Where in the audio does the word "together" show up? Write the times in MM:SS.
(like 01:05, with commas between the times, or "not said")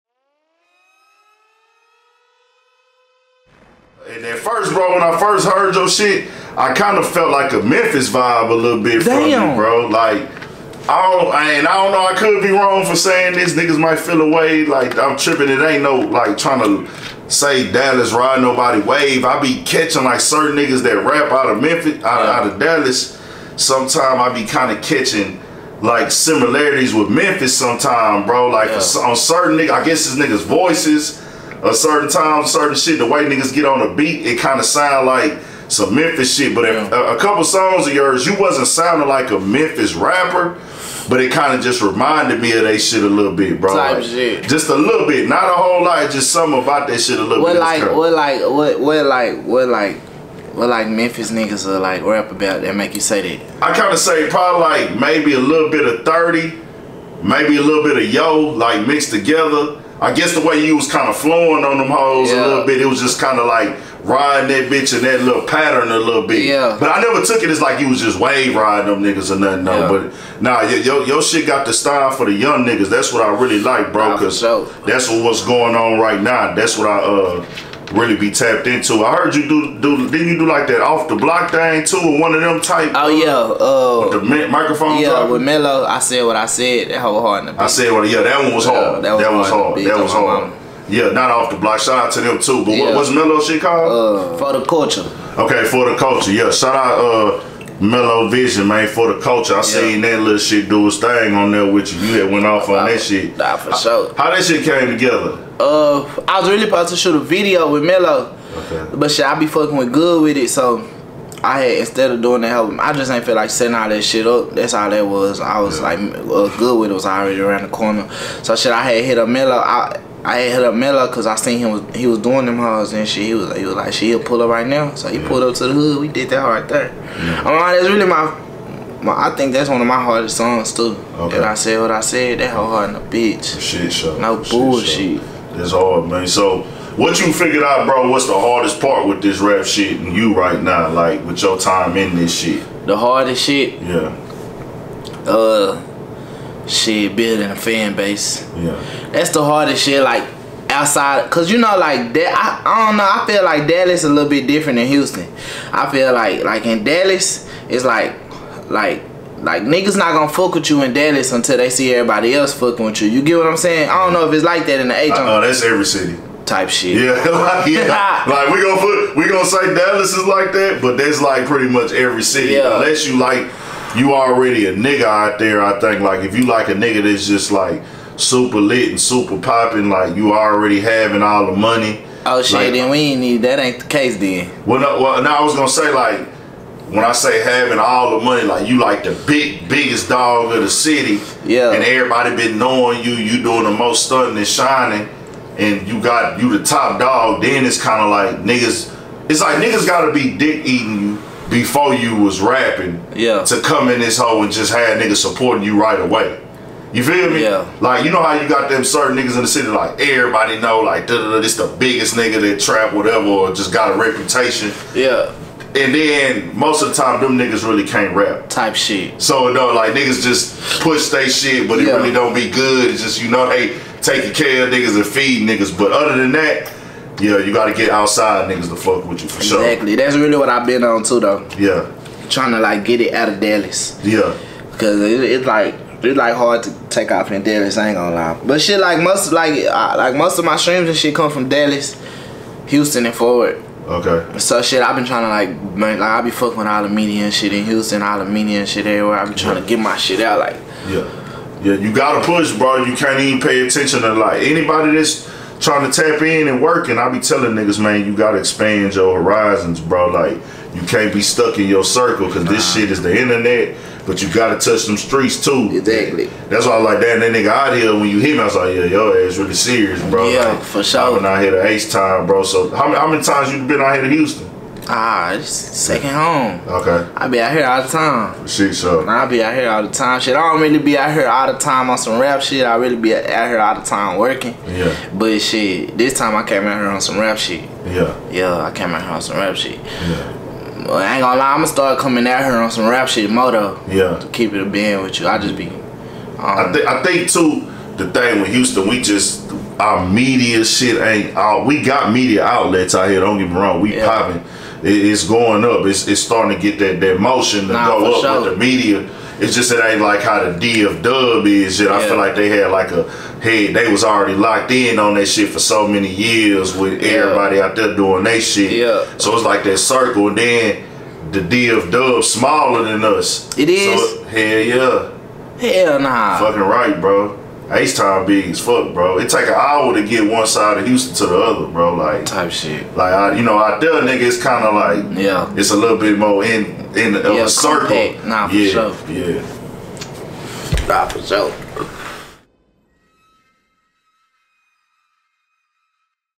00:59, 01:44.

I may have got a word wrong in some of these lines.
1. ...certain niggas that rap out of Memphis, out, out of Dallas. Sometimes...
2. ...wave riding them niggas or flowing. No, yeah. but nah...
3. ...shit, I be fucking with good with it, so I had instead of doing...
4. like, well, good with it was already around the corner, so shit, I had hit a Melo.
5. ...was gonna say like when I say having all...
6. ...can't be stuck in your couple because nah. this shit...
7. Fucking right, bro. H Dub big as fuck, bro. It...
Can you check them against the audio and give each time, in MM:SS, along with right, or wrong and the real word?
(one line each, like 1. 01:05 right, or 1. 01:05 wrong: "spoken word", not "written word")
1. 00:20 right
2. 01:08 wrong: "nothing", not "flowing"
3. 01:49 right
4. 01:55 right
5. 03:05 right
6. 04:20 wrong: "circle", not "couple"
7. 05:26 wrong: "Town", not "Dub".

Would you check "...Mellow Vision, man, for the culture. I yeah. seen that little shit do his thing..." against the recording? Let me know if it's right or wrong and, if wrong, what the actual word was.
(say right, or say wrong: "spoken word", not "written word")
right.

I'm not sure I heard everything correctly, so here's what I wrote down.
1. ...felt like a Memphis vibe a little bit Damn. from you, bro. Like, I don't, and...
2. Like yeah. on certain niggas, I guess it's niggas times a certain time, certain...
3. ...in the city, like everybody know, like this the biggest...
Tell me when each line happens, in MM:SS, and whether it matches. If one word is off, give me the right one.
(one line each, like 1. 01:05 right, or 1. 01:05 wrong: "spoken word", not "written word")
1. 00:07 right
2. 00:28 wrong: "voices", not "times"
3. 03:29 right.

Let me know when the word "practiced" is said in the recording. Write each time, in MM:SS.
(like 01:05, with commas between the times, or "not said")
not said.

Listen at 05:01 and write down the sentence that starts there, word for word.
We got media outlets out here.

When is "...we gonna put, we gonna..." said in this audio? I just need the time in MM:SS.
02:48.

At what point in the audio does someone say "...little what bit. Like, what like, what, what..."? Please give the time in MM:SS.
00:47.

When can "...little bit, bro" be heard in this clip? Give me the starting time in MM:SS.
00:43.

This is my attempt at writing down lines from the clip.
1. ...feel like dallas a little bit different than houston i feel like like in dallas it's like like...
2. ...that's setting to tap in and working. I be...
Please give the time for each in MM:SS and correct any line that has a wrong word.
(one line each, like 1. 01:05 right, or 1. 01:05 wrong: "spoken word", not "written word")
1. 02:33 right
2. 04:14 wrong: "trying", not "setting".